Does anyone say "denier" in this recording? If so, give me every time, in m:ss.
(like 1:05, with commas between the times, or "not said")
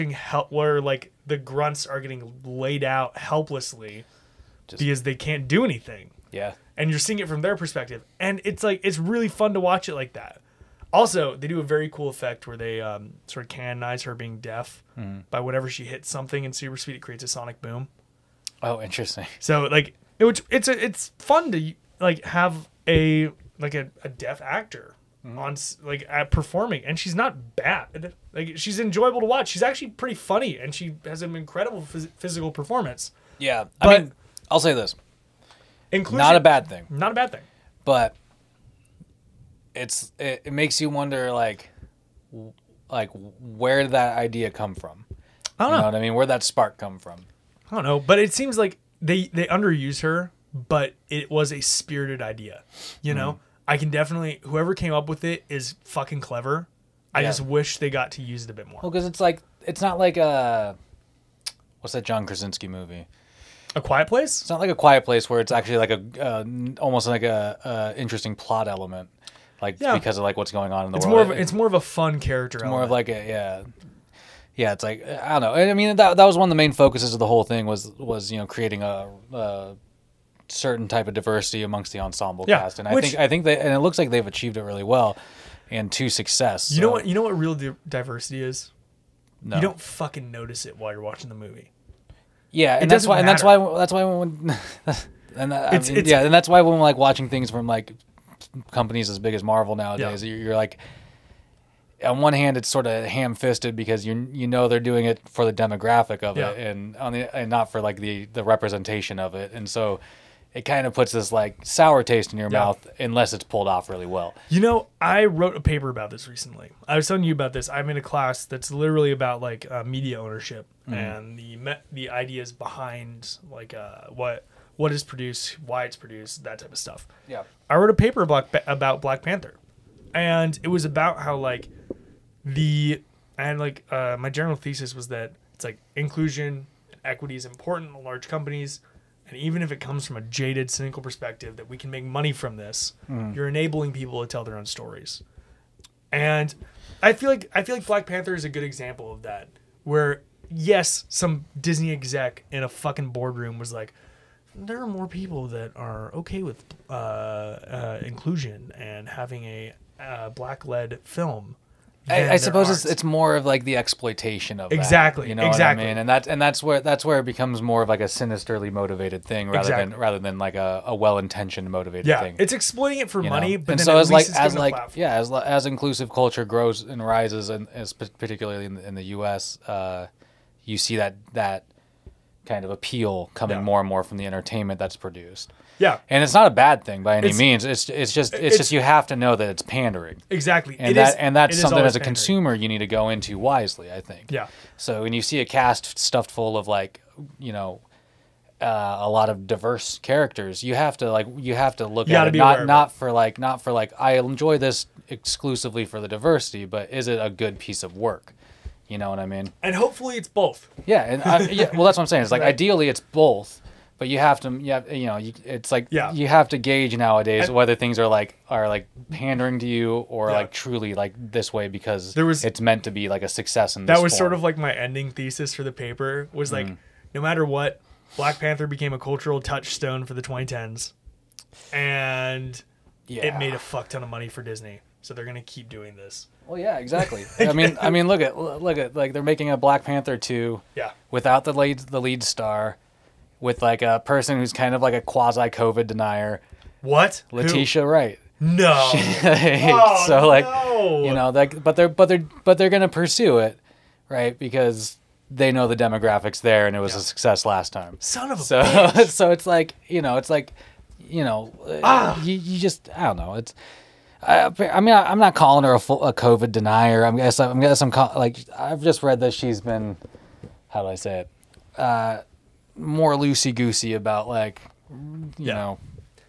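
4:05, 4:26.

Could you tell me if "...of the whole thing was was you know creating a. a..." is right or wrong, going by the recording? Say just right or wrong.
right.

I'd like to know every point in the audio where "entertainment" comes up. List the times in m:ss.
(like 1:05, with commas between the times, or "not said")
3:04.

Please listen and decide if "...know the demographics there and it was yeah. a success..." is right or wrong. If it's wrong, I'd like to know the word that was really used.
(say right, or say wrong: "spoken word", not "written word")
right.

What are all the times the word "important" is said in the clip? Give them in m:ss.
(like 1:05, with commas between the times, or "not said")
2:17.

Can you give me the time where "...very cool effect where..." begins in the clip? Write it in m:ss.
0:11.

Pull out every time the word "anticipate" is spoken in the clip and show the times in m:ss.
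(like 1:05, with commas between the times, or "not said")
not said.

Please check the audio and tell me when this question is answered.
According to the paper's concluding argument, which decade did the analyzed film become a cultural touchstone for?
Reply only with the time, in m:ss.
3:50.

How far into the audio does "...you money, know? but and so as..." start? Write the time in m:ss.
2:53.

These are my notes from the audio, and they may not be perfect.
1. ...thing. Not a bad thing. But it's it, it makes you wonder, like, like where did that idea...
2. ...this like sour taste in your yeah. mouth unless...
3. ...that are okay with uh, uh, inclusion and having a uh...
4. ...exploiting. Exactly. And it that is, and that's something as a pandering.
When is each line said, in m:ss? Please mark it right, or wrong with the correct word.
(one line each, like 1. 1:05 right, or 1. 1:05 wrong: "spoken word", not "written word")
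1. 0:36 right
2. 1:51 right
3. 2:35 right
4. 3:09 wrong: "pandering", not "exploiting".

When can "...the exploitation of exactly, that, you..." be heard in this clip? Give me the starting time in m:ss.
2:43.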